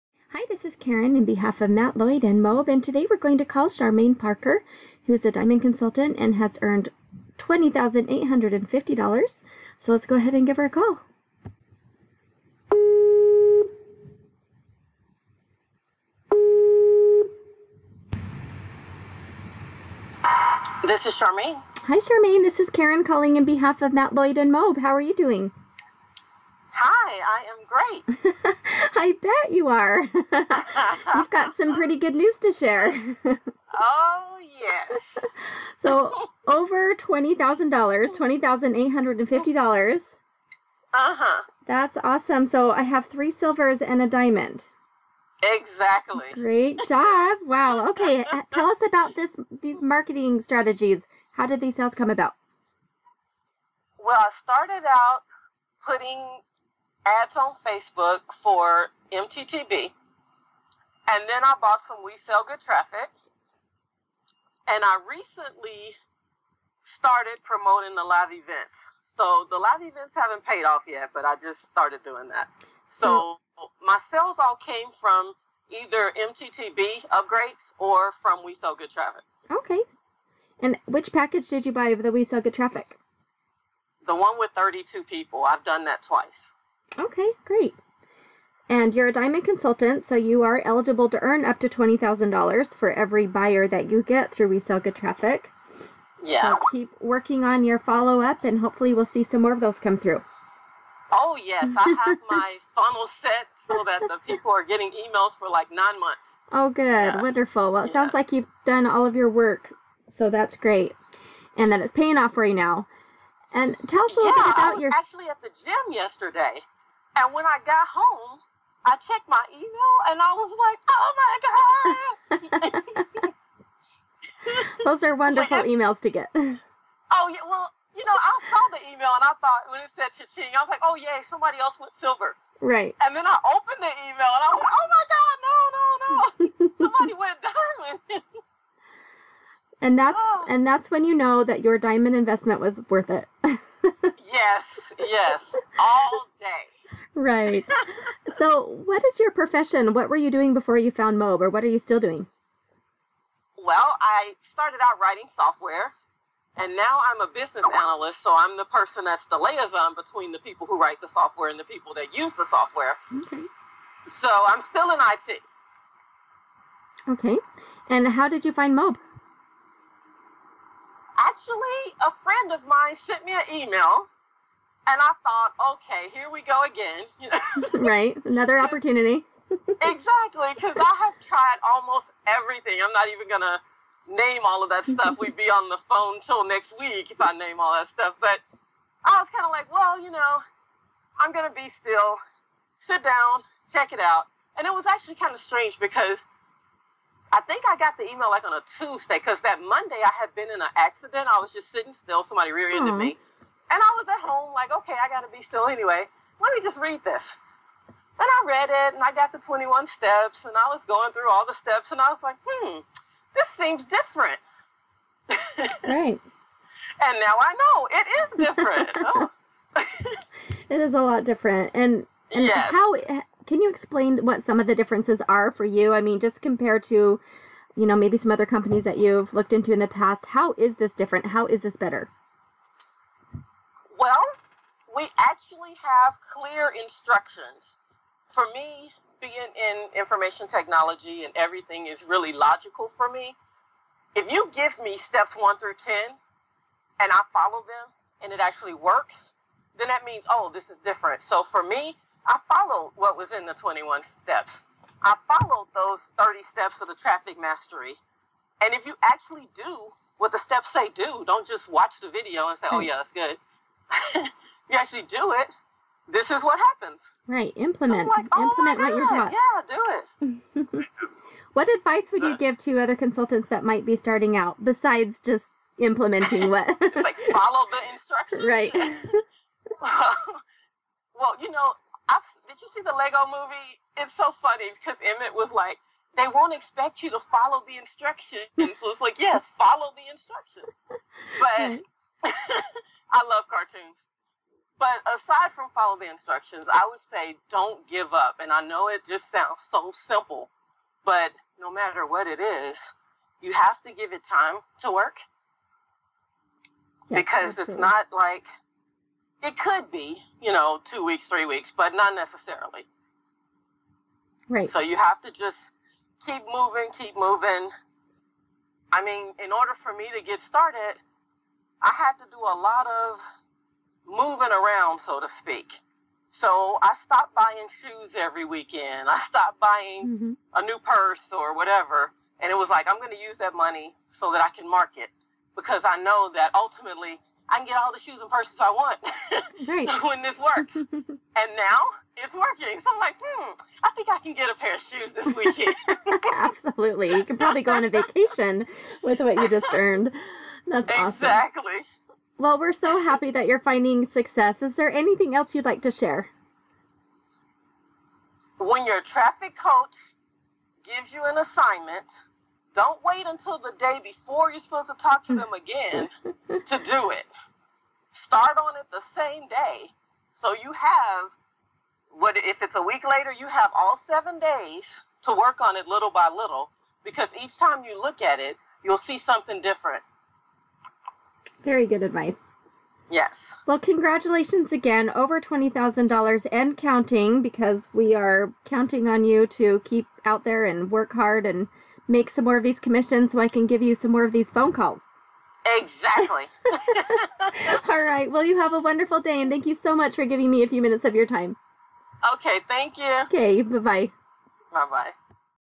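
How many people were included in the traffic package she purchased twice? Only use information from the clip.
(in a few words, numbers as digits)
32.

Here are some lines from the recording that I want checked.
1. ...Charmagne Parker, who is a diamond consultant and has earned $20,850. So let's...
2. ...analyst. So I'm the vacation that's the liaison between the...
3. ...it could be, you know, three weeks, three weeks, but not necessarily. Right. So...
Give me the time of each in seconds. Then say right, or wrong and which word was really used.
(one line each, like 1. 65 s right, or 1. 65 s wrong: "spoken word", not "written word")
1. 3 s right
2. 157 s wrong: "person", not "vacation"
3. 309 s wrong: "two", not "three".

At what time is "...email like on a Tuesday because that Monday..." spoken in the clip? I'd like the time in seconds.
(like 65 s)
198 s.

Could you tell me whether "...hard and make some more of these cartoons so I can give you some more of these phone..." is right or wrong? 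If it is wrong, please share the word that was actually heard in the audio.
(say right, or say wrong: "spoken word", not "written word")
wrong: "commissions", not "cartoons".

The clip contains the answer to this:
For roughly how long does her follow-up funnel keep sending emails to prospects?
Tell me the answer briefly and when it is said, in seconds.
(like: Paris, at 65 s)
9 months, at 105 s.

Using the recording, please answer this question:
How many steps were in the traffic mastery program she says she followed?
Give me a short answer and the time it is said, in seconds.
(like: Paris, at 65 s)
30, at 256 s.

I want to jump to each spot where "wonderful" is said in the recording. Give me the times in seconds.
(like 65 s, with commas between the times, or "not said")
107 s, 125 s, 398 s.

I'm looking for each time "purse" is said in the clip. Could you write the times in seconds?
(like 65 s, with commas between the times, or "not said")
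330 s, 338 s.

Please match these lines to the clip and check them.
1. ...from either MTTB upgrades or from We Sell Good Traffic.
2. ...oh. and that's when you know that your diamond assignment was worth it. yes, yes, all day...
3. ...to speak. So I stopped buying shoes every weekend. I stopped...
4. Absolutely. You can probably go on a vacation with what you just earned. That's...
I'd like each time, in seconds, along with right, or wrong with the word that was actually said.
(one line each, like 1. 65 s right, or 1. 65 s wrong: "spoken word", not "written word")
1. 74 s right
2. 140 s wrong: "investment", not "assignment"
3. 325 s right
4. 346 s right.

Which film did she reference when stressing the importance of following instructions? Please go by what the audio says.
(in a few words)
The Lego Movie.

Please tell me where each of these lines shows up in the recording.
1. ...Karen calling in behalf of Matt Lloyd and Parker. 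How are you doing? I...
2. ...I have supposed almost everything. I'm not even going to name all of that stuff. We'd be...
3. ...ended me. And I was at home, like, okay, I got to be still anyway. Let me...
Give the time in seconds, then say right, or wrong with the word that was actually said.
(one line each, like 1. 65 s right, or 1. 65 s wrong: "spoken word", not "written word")
1. 22 s wrong: "MOBE", not "Parker"
2. 180 s wrong: "tried", not "supposed"
3. 202 s right.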